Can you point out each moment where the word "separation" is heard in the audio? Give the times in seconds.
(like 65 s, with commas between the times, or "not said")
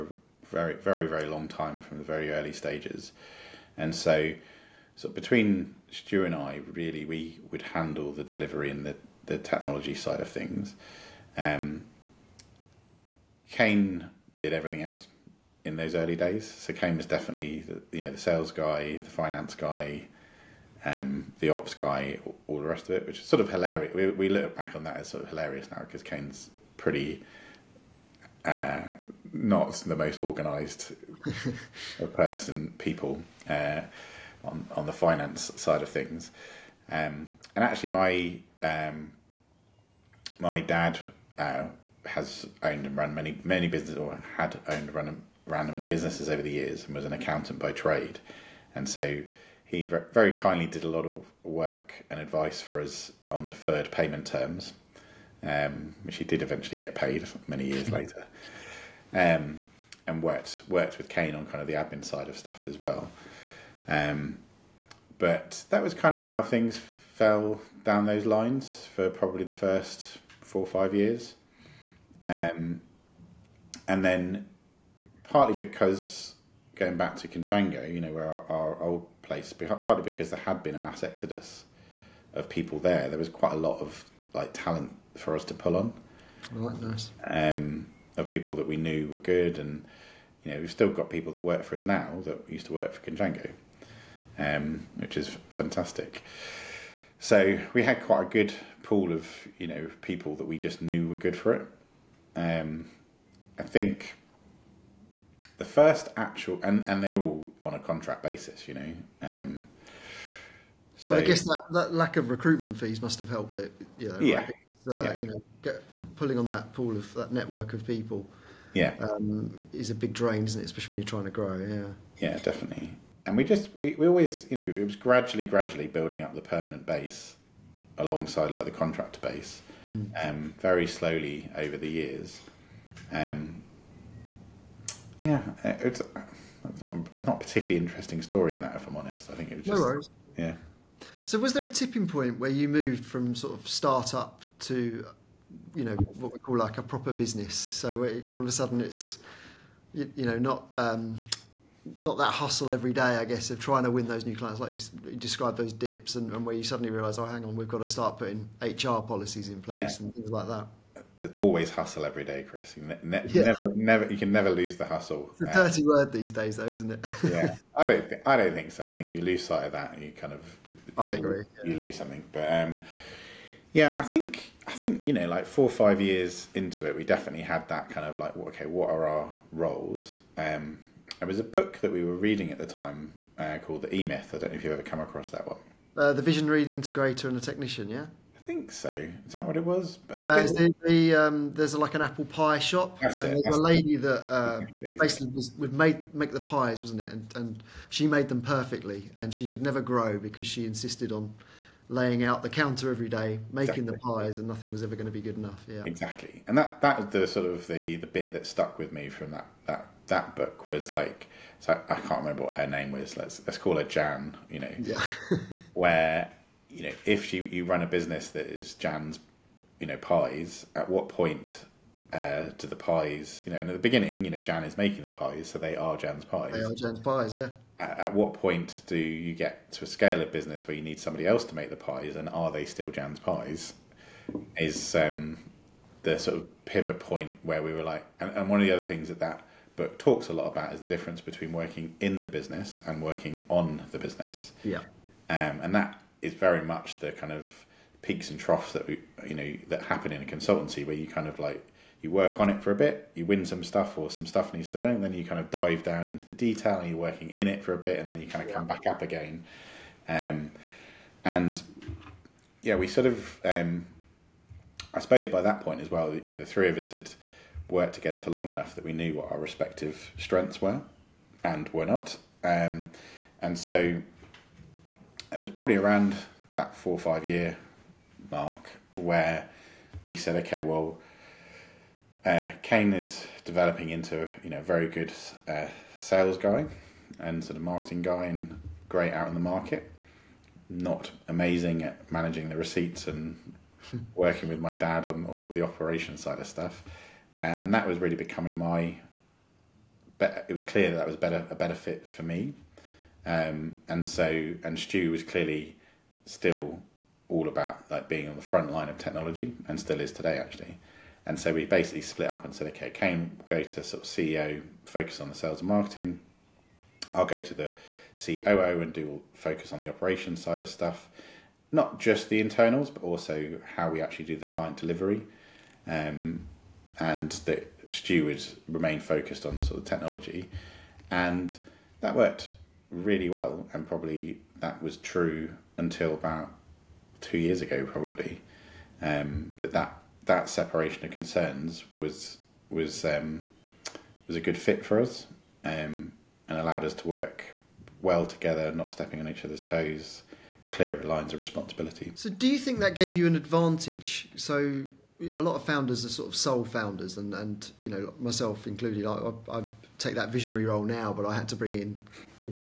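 340 s.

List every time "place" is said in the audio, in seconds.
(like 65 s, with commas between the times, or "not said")
79 s, 159 s.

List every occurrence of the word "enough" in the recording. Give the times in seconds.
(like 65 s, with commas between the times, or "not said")
205 s, 268 s.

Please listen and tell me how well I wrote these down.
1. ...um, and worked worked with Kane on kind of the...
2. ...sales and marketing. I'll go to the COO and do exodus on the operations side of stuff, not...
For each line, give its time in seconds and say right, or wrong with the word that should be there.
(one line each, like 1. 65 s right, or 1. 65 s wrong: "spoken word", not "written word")
1. 59 s right
2. 315 s wrong: "focus", not "exodus".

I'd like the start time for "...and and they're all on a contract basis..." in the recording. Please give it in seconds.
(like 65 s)
106 s.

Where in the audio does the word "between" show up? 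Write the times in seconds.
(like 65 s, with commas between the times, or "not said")
5 s, 241 s.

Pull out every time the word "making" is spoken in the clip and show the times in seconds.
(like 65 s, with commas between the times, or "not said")
203 s, 224 s.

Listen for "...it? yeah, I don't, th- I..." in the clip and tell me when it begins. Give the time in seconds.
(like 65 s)
166 s.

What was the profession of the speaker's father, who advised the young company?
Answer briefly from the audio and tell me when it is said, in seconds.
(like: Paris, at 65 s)
Accountant, at 47 s.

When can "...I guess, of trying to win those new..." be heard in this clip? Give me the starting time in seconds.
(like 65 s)
153 s.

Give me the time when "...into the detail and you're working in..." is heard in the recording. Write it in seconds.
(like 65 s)
256 s.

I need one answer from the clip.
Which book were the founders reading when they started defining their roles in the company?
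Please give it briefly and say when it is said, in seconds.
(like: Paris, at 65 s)
The E Myth, at 183 s.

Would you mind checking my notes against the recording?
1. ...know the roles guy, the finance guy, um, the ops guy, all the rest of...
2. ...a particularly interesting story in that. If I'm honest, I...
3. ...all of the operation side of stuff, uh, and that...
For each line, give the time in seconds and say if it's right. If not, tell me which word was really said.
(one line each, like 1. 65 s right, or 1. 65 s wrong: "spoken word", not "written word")
1. 18 s wrong: "sales", not "roles"
2. 137 s right
3. 295 s right.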